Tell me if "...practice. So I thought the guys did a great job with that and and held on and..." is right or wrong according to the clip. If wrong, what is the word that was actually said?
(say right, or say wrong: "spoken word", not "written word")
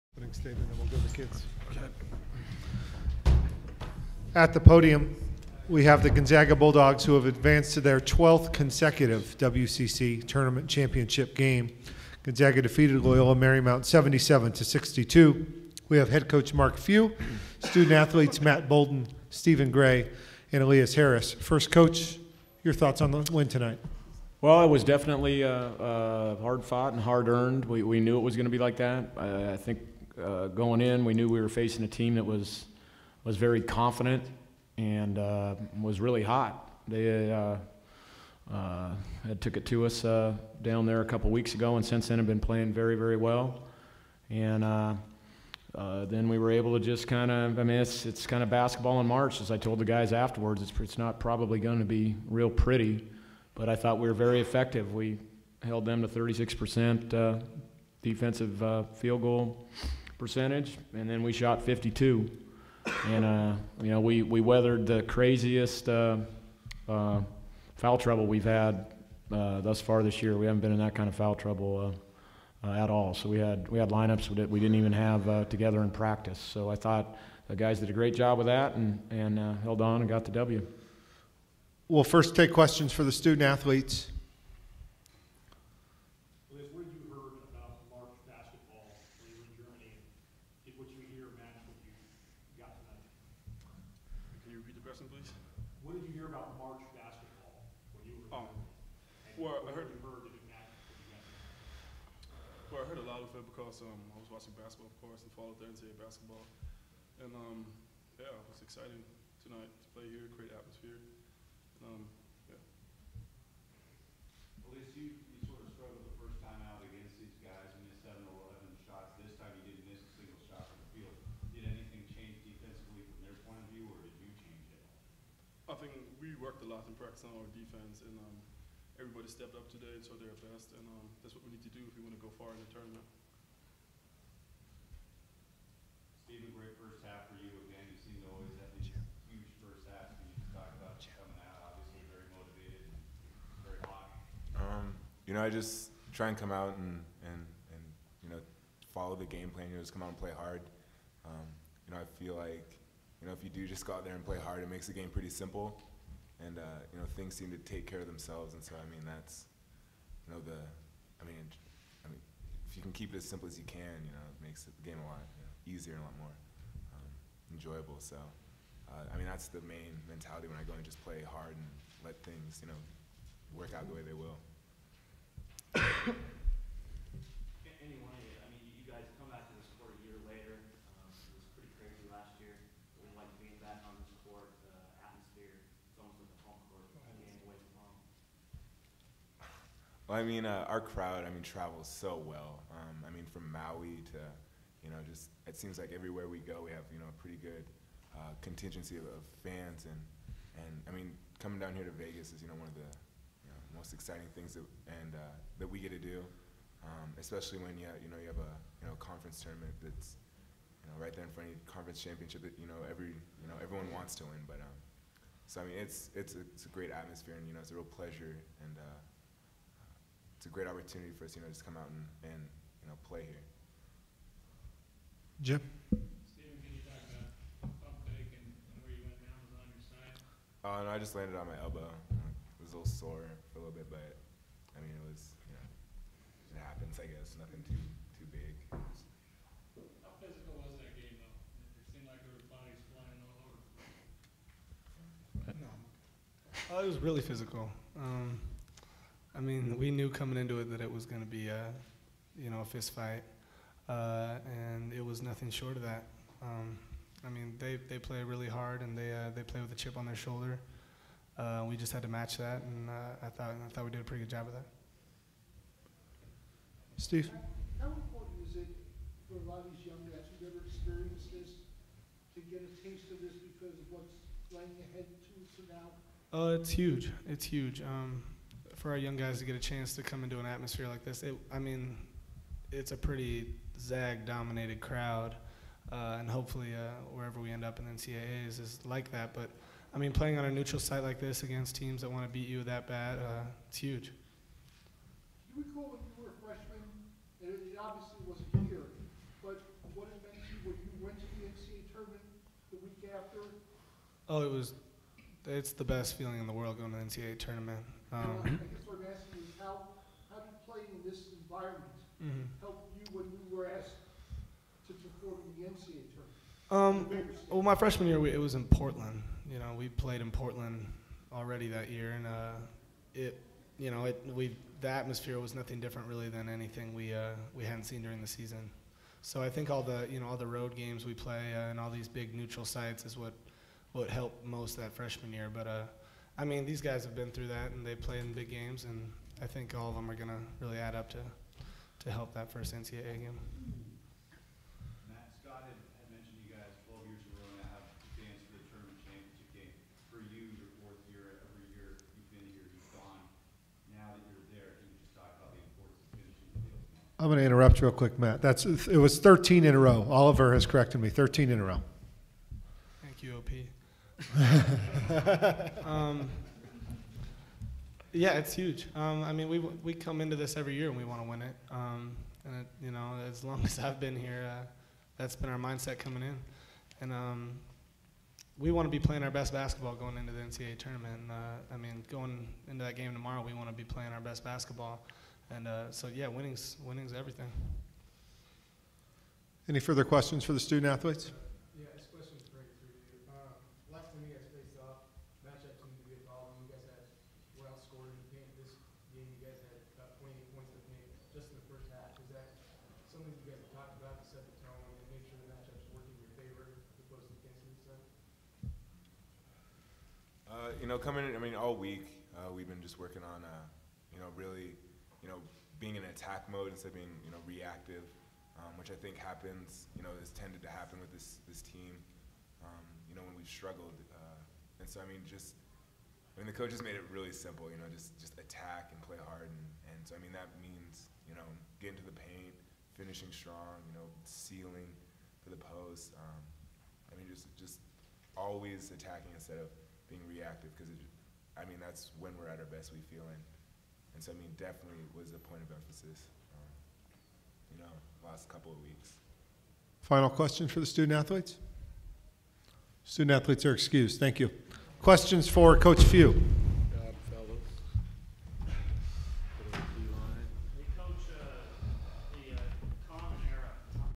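right.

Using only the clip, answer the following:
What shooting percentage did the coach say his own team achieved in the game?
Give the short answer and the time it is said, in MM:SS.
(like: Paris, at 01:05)
52, at 01:01.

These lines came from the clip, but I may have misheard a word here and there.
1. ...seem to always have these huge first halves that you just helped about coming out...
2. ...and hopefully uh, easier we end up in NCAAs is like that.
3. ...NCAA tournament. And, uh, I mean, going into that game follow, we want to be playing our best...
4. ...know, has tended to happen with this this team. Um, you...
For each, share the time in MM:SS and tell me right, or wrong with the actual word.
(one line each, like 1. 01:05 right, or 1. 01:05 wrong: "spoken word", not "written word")
1. 02:17 wrong: "talked", not "helped"
2. 04:46 wrong: "wherever", not "easier"
3. 06:20 wrong: "tomorrow", not "follow"
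4. 07:00 right.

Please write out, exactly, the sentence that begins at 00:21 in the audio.
First coach, your thoughts on the win tonight?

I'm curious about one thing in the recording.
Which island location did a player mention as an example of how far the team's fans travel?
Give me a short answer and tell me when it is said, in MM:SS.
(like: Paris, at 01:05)
Maui, at 03:13.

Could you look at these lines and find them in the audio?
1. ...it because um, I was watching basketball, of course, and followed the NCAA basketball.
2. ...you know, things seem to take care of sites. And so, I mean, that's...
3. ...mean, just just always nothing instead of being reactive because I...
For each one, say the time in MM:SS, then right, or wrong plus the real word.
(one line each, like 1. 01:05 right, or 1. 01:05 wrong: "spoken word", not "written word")
1. 01:43 right
2. 02:36 wrong: "themselves", not "sites"
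3. 07:17 wrong: "attacking", not "nothing".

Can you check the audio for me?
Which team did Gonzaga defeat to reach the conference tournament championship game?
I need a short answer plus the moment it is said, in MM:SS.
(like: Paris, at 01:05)
Loyola Marymount, at 00:13.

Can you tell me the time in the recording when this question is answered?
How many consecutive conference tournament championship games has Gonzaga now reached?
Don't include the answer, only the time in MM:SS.
00:07.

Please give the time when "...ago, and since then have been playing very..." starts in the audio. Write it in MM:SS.
00:41.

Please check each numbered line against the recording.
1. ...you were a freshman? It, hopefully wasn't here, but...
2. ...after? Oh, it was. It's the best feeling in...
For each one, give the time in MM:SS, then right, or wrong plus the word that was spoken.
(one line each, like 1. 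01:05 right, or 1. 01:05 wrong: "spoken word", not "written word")
1. 04:56 wrong: "obviously", not "hopefully"
2. 05:03 right.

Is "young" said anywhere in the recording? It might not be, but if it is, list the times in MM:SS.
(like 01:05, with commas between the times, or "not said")
04:29, 04:38.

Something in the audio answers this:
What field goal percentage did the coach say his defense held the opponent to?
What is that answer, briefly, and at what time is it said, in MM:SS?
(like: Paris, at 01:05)
36%, at 00:56.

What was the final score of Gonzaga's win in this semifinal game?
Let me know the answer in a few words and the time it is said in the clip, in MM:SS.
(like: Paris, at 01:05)
77 to 62, at 00:13.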